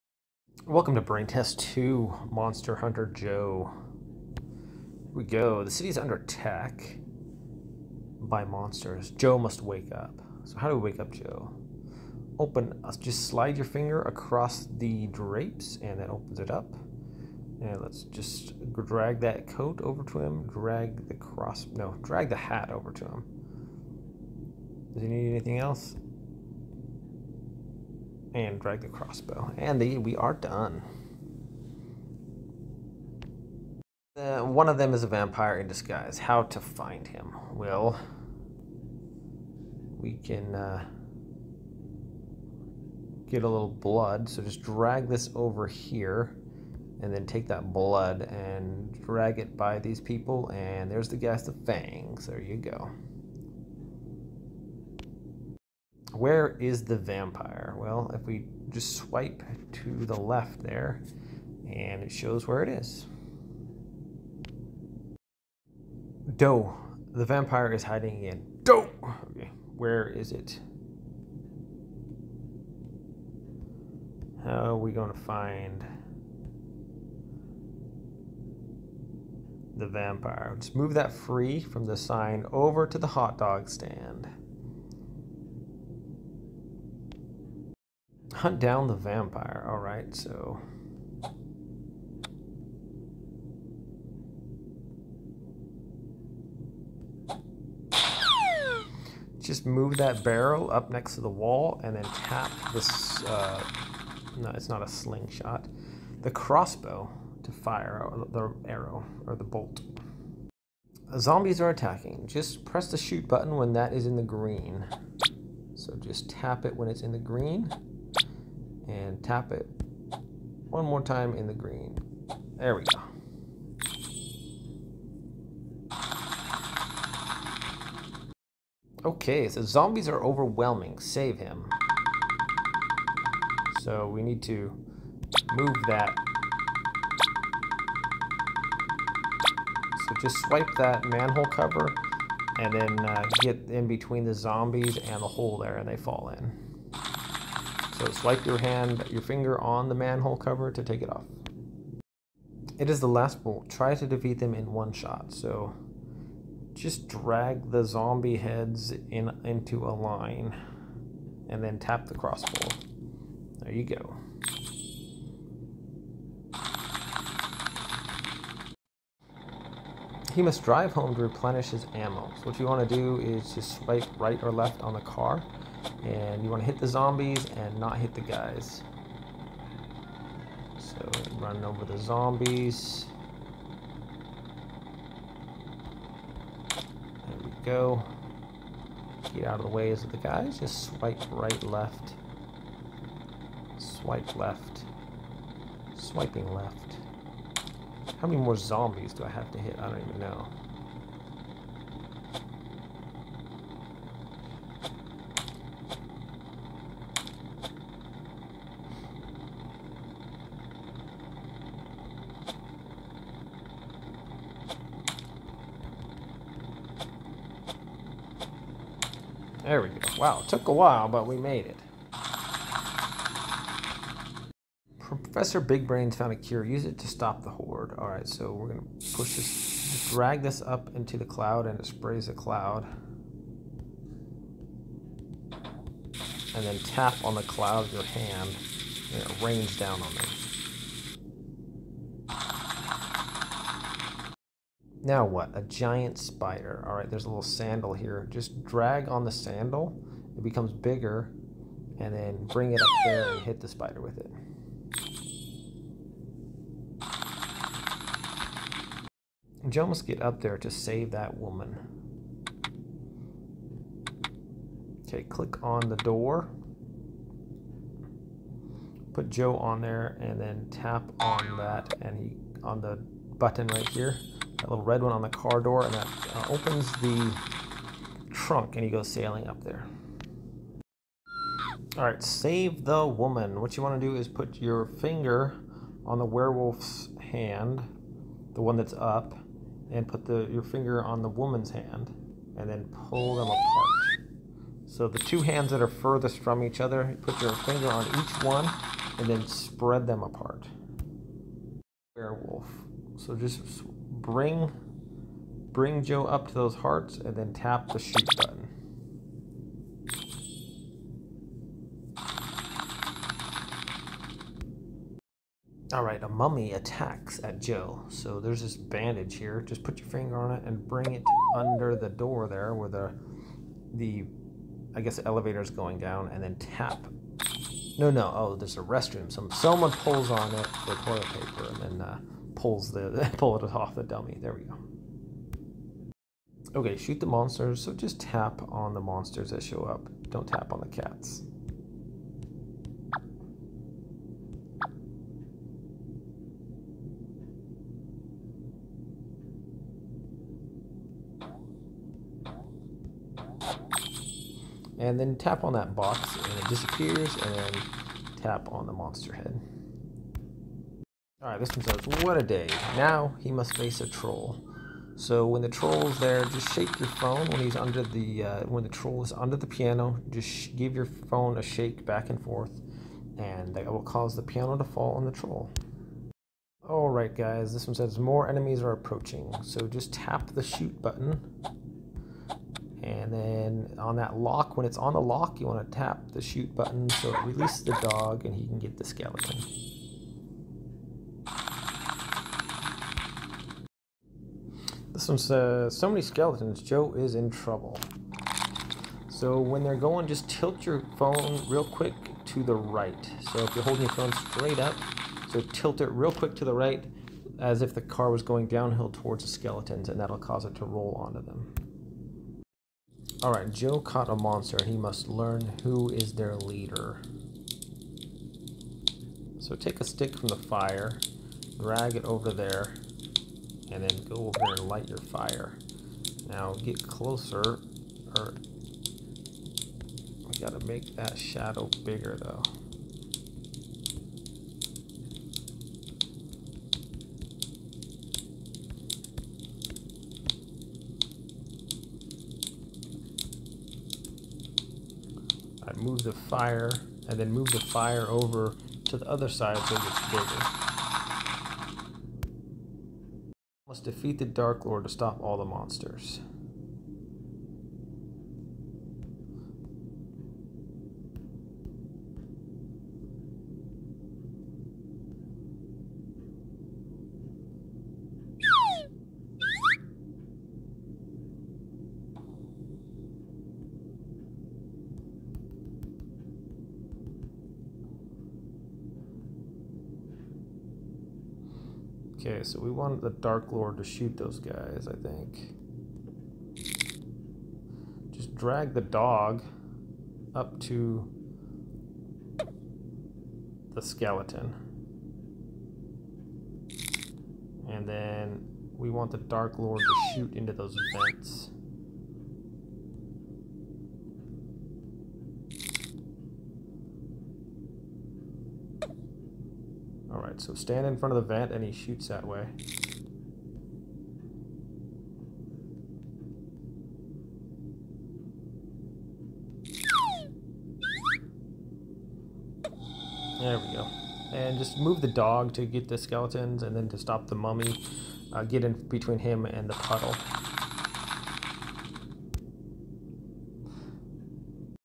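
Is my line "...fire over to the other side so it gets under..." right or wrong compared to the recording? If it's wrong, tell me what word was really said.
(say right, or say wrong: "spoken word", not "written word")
wrong: "bigger", not "under".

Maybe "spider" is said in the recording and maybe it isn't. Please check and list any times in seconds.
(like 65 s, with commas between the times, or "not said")
246 s, 253 s.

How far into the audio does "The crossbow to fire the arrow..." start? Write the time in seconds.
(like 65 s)
106 s.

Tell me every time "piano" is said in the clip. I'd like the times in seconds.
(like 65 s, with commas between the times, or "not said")
369 s, 374 s.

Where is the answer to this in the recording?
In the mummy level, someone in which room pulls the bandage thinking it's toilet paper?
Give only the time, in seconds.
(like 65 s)
328 s.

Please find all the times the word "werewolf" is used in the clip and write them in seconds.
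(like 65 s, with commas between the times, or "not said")
286 s, 302 s.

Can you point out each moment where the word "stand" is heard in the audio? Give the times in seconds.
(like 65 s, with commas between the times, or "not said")
83 s, 510 s.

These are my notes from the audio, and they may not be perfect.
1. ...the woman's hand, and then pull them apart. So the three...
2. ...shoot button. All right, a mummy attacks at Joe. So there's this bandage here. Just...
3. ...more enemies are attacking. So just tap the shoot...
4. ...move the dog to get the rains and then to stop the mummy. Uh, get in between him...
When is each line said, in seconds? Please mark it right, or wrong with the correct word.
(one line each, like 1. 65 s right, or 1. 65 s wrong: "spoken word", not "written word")
1. 291 s wrong: "two", not "three"
2. 307 s right
3. 378 s wrong: "approaching", not "attacking"
4. 524 s wrong: "skeletons", not "rains".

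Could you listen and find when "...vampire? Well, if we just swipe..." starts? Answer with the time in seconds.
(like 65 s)
56 s.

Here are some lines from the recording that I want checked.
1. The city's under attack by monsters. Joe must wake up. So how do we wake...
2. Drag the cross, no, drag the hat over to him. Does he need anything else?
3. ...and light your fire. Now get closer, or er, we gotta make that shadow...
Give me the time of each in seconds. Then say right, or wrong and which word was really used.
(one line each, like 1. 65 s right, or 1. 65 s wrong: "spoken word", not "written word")
1. 5 s right
2. 20 s right
3. 424 s right.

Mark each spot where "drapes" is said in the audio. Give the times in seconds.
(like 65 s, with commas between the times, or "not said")
15 s.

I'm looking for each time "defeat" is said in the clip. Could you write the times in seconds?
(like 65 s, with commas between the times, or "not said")
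154 s, 454 s.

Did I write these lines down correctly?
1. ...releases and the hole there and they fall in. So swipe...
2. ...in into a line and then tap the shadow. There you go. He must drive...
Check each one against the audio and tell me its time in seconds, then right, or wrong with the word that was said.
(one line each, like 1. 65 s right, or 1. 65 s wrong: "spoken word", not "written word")
1. 144 s wrong: "zombies", not "releases"
2. 159 s wrong: "crossbow", not "shadow".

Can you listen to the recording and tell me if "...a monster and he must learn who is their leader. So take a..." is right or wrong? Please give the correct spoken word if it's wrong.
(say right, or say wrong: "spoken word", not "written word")
right.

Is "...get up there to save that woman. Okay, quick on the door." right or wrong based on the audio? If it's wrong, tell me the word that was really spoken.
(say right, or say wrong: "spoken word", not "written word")
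wrong: "click", not "quick".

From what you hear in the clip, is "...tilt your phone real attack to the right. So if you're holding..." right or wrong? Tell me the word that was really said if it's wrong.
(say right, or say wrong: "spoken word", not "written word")
wrong: "quick", not "attack".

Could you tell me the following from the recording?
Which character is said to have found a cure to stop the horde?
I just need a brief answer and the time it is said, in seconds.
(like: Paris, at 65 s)
Professor Big Brains, at 224 s.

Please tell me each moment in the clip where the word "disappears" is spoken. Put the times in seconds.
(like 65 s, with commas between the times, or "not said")
356 s.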